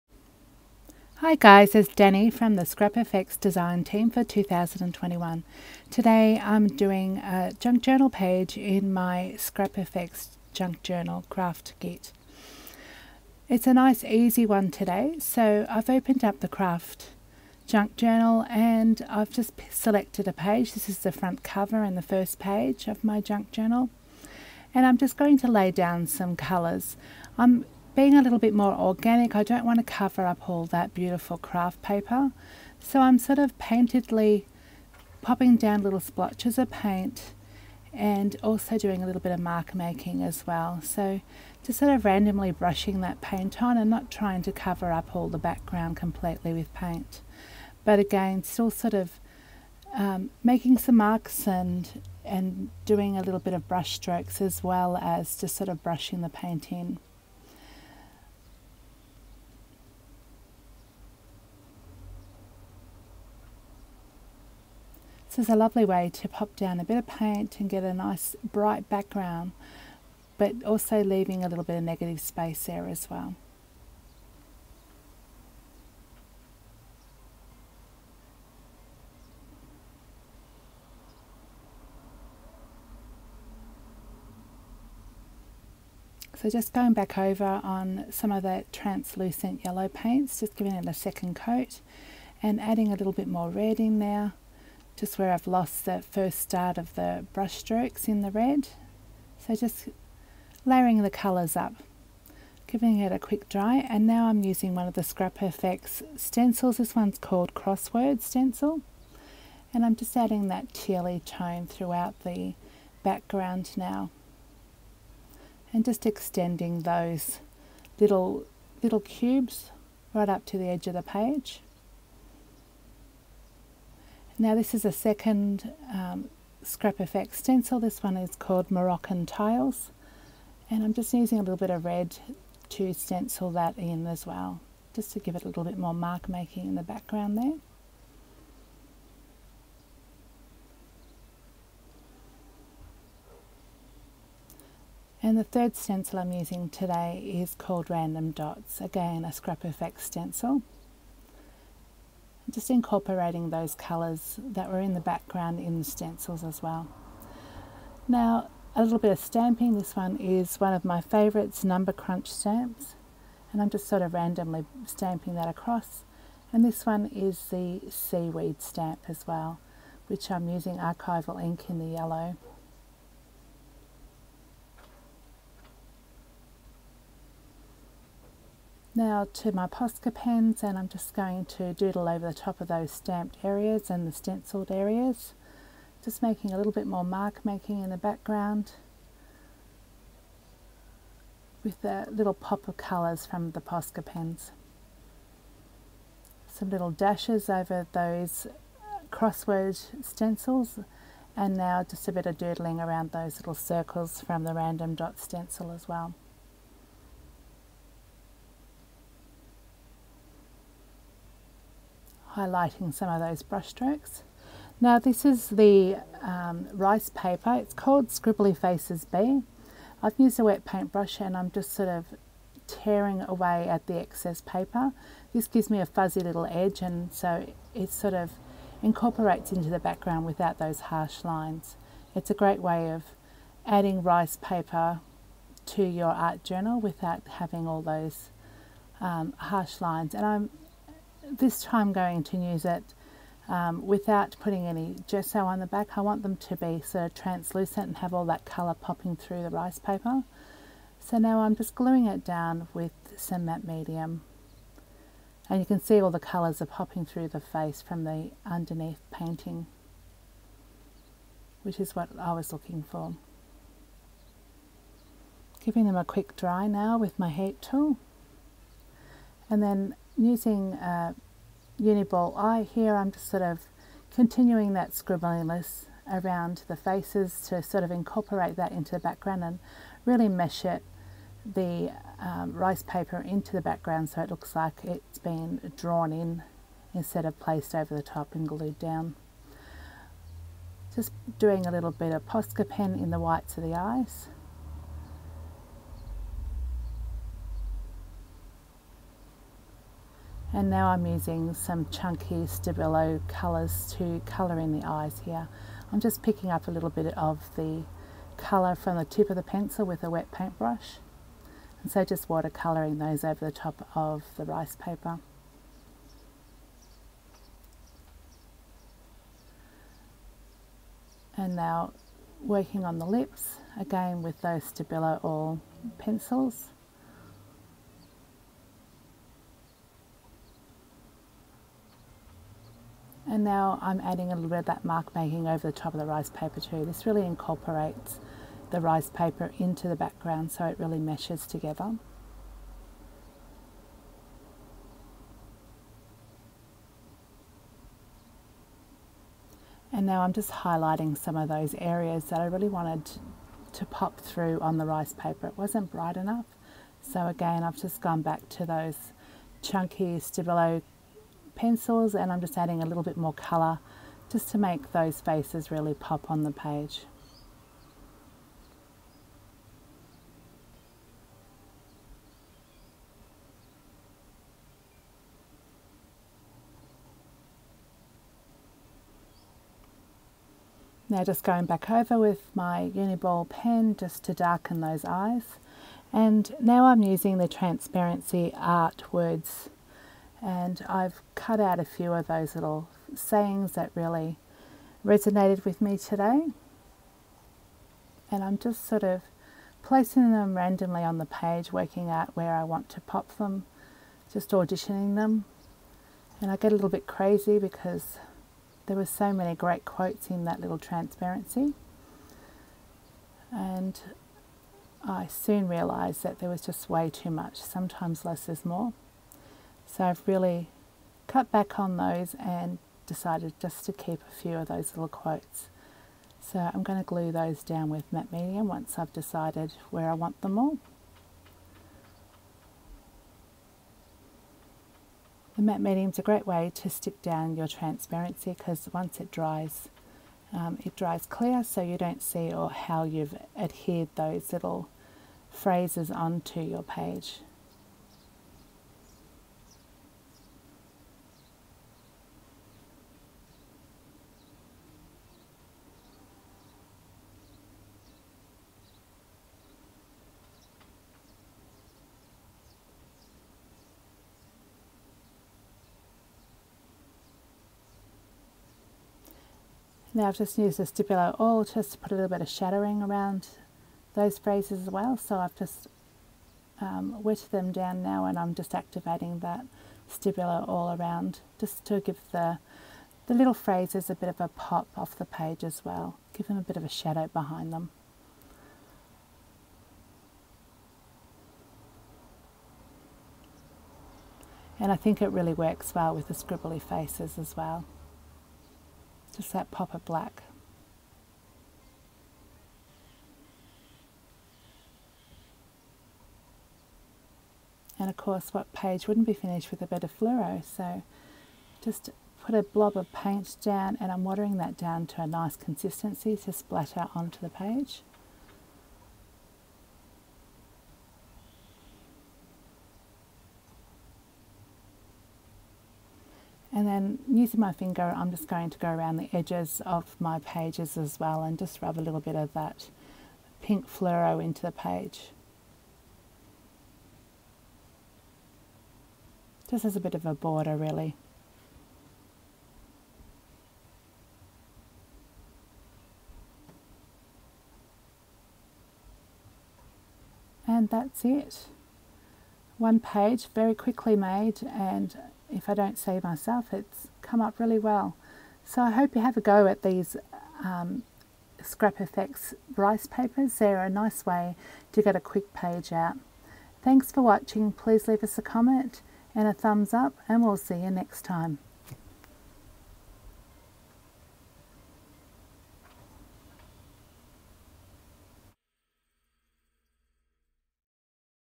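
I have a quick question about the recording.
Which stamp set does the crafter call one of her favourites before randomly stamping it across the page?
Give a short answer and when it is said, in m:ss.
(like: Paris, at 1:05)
Number Crunch, at 2:41.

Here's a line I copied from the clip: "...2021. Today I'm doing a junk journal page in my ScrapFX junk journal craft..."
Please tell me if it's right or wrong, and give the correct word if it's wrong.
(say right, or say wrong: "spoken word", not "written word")
right.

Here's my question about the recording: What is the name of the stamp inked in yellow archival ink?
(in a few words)
Seaweed.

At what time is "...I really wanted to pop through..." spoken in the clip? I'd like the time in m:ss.
5:52.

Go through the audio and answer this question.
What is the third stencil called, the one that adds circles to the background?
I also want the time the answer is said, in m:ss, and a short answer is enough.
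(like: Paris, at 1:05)
Random Dots, at 2:27.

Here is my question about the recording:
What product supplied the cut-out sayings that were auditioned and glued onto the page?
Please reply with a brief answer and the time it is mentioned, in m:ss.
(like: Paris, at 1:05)
Transparency Art Words, at 6:27.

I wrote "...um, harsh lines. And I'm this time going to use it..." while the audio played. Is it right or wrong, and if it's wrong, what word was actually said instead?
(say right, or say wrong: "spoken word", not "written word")
right.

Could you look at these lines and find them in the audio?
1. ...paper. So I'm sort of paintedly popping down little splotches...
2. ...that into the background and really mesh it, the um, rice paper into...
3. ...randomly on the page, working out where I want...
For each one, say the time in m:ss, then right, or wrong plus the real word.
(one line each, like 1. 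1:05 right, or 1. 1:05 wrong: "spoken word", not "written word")
1. 0:31 right
2. 4:38 right
3. 6:40 right.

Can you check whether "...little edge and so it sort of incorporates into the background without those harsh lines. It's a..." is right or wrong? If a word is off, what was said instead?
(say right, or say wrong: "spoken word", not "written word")
right.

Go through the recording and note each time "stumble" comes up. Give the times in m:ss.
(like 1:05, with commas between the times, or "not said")
not said.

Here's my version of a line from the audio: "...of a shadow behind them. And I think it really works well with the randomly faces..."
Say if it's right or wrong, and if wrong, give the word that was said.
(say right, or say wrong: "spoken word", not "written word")
wrong: "scribbly", not "randomly".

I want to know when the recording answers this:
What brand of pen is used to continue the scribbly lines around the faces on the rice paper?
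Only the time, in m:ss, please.
4:31.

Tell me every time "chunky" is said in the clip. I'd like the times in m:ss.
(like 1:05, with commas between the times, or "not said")
5:01, 5:59.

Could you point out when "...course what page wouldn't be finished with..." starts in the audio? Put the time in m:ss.
8:28.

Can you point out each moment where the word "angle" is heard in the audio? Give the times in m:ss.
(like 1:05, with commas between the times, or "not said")
not said.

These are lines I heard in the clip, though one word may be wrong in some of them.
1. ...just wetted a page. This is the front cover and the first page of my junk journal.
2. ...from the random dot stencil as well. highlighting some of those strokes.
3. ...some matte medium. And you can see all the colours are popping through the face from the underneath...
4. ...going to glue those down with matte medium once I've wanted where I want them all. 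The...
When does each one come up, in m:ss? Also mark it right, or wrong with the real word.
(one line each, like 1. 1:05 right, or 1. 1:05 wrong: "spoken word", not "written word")
1. 0:19 wrong: "selected", not "wetted"
2. 3:24 wrong: "brushstrokes", not "strokes"
3. 4:13 right
4. 7:06 wrong: "decided", not "wanted".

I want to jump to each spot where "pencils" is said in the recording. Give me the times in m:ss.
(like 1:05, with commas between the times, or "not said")
5:09, 5:25, 6:01.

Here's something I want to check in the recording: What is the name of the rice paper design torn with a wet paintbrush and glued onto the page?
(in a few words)
Scribbly Faces B.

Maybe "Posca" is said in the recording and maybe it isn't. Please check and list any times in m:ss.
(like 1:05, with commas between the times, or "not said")
2:59, 3:13, 4:52.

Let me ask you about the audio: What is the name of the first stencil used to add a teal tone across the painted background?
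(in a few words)
Crossword Stencil.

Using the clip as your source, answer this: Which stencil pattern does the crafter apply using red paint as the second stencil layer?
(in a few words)
Moroccan Tiles.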